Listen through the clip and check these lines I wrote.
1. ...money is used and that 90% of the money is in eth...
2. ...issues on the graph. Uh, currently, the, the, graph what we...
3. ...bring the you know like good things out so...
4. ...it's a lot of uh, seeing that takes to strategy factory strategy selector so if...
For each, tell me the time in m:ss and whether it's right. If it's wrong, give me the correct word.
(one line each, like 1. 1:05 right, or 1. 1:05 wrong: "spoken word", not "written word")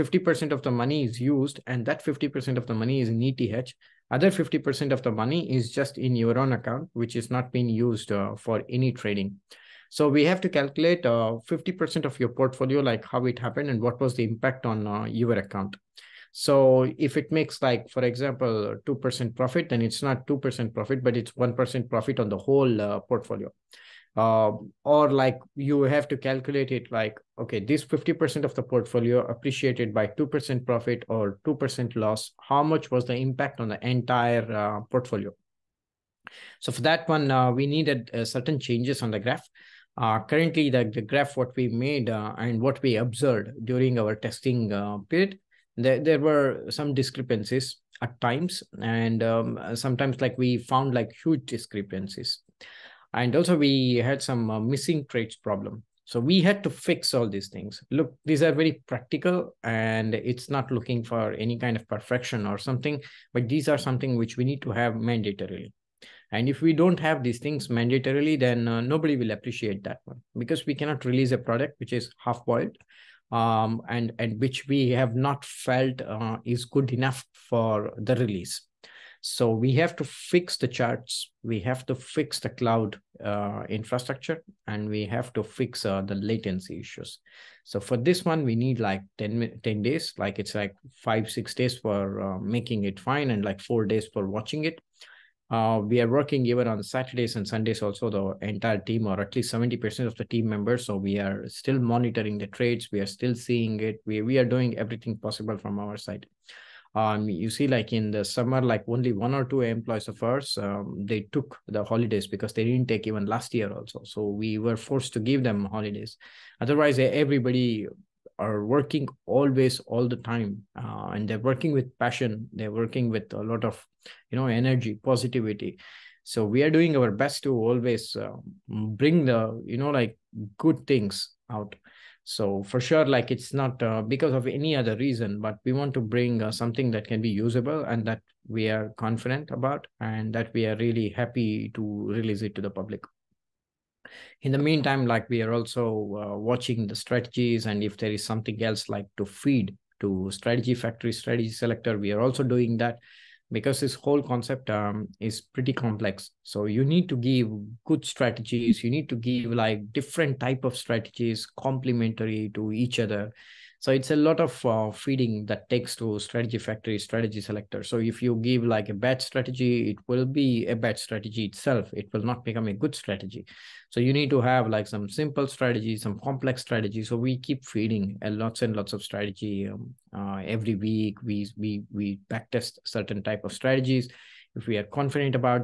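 1. 0:00 wrong: "50", not "90"
2. 0:38 wrong: "changes", not "issues"
3. 2:08 right
4. 2:43 wrong: "feeding", not "seeing".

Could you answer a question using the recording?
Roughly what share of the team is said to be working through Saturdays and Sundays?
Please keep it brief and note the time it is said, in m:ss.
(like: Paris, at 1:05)
70%, at 1:39.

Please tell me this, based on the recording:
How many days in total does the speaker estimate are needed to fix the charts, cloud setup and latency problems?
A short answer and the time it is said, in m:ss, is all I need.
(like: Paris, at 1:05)
10 days, at 1:29.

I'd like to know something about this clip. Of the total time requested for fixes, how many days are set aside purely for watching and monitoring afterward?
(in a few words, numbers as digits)
4 days.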